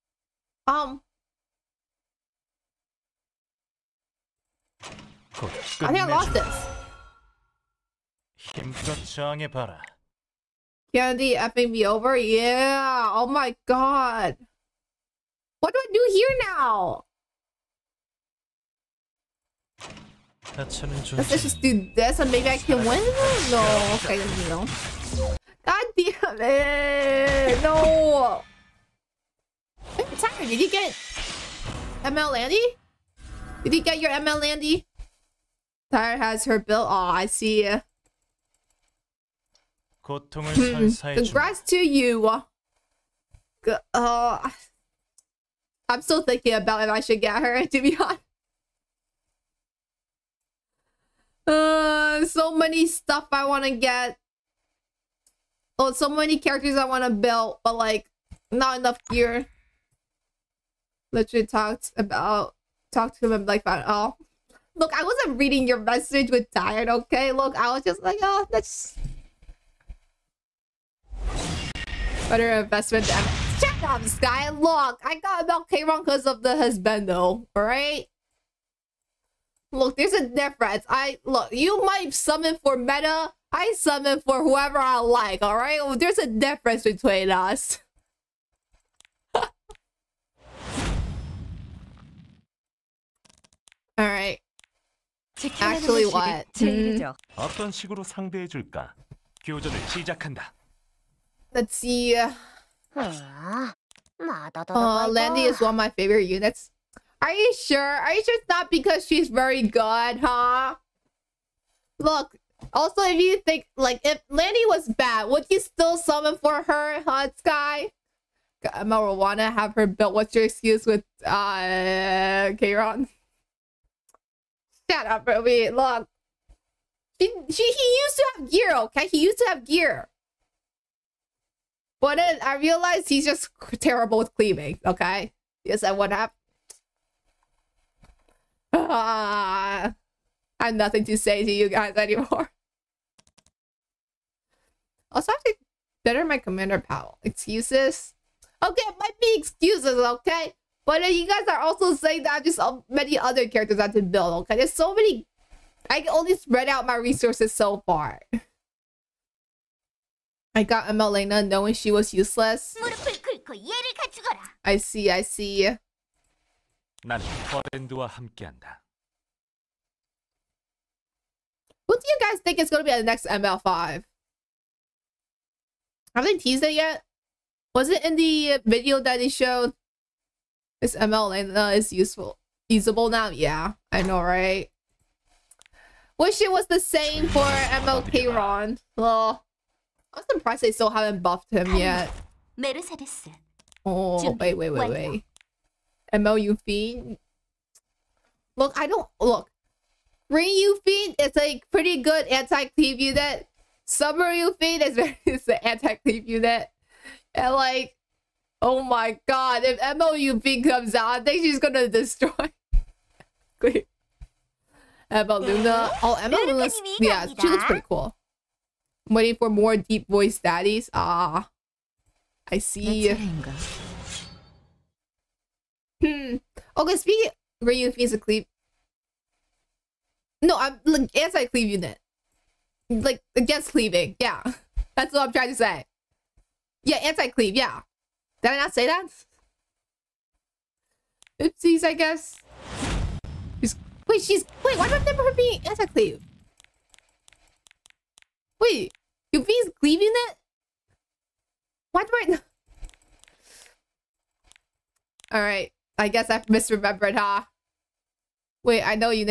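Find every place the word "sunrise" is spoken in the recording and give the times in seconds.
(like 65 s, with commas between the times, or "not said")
not said.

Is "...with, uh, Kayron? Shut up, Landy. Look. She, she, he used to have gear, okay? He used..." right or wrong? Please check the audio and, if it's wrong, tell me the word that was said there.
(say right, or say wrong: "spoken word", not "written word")
wrong: "Ruby", not "Landy".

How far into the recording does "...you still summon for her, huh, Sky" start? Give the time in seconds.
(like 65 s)
115 s.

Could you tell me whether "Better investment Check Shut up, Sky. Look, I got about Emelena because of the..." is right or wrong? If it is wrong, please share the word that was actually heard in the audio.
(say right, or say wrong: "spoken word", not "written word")
wrong: "Kayron", not "Emelena".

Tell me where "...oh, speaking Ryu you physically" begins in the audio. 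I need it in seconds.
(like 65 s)
226 s.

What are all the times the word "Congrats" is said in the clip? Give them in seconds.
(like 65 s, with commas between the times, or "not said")
41 s.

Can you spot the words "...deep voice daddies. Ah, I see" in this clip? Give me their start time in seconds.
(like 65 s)
219 s.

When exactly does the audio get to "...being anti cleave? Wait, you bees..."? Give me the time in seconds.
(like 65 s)
245 s.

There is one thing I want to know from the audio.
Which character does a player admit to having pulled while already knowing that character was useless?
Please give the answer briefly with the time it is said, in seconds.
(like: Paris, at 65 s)
Emelena, at 160 s.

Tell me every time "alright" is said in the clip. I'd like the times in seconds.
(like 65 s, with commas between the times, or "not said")
77 s, 85 s, 93 s, 255 s.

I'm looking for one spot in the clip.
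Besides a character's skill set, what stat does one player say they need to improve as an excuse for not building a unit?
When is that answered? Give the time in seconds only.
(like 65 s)
146 s.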